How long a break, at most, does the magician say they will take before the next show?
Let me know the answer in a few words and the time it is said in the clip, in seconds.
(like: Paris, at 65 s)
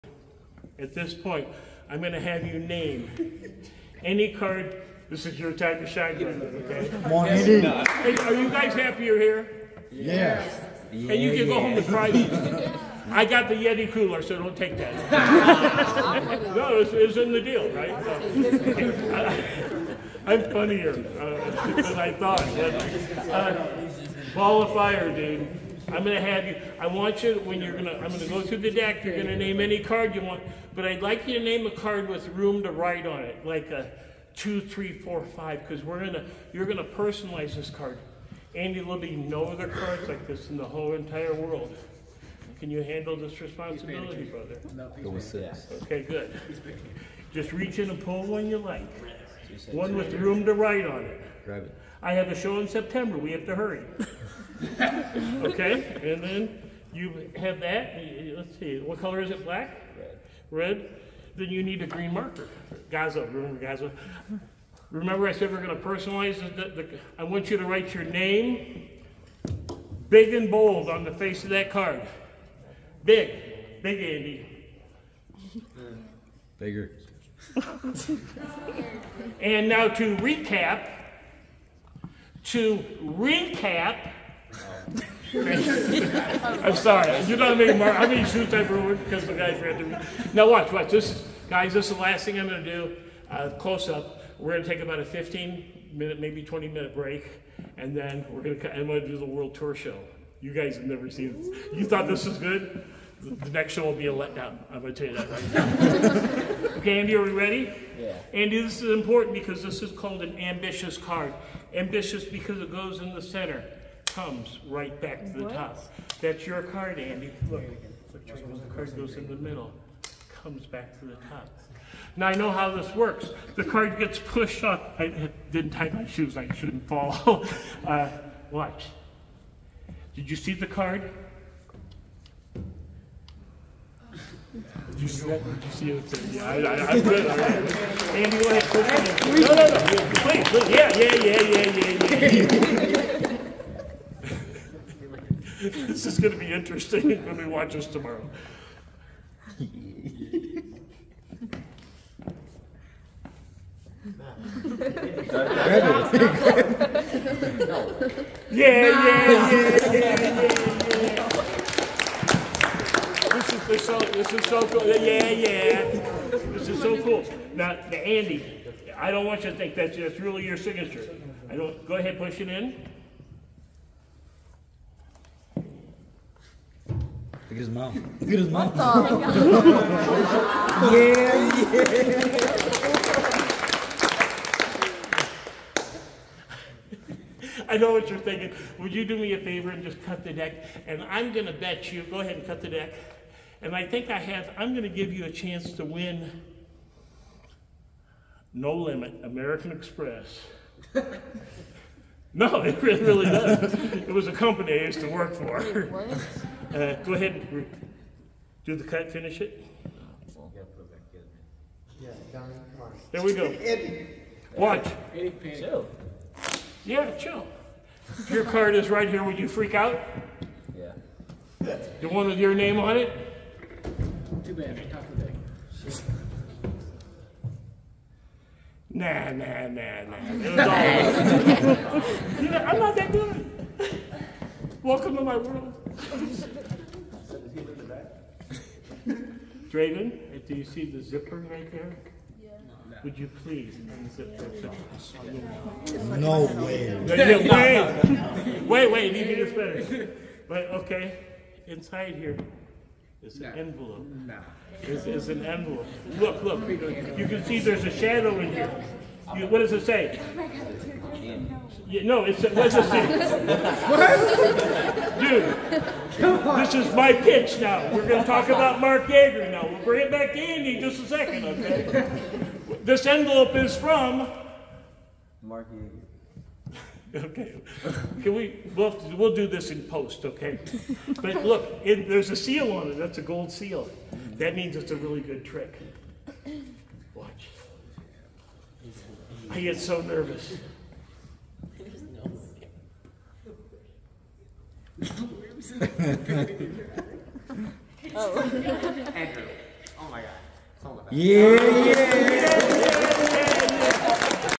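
20 minutes, at 96 s.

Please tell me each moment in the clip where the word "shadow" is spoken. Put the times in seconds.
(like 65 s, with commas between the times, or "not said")
257 s.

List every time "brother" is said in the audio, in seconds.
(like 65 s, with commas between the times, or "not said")
6 s, 44 s.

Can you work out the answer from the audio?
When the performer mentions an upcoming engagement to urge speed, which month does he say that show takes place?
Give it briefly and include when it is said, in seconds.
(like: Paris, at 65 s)
September, at 52 s.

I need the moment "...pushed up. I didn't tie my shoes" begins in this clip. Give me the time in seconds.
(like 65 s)
124 s.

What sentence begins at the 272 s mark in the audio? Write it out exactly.
This envelope is from Mark Yeager.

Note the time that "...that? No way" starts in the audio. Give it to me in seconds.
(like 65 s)
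245 s.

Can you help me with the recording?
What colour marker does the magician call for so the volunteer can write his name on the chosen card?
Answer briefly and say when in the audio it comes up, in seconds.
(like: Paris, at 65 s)
green, at 61 s.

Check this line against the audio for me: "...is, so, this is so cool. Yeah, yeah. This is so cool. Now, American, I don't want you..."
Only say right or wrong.
wrong.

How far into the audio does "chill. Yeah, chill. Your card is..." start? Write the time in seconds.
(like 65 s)
215 s.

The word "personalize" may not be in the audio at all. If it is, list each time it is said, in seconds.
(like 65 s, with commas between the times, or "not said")
36 s, 65 s.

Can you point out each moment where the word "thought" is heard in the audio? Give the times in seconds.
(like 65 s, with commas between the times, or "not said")
22 s, 101 s.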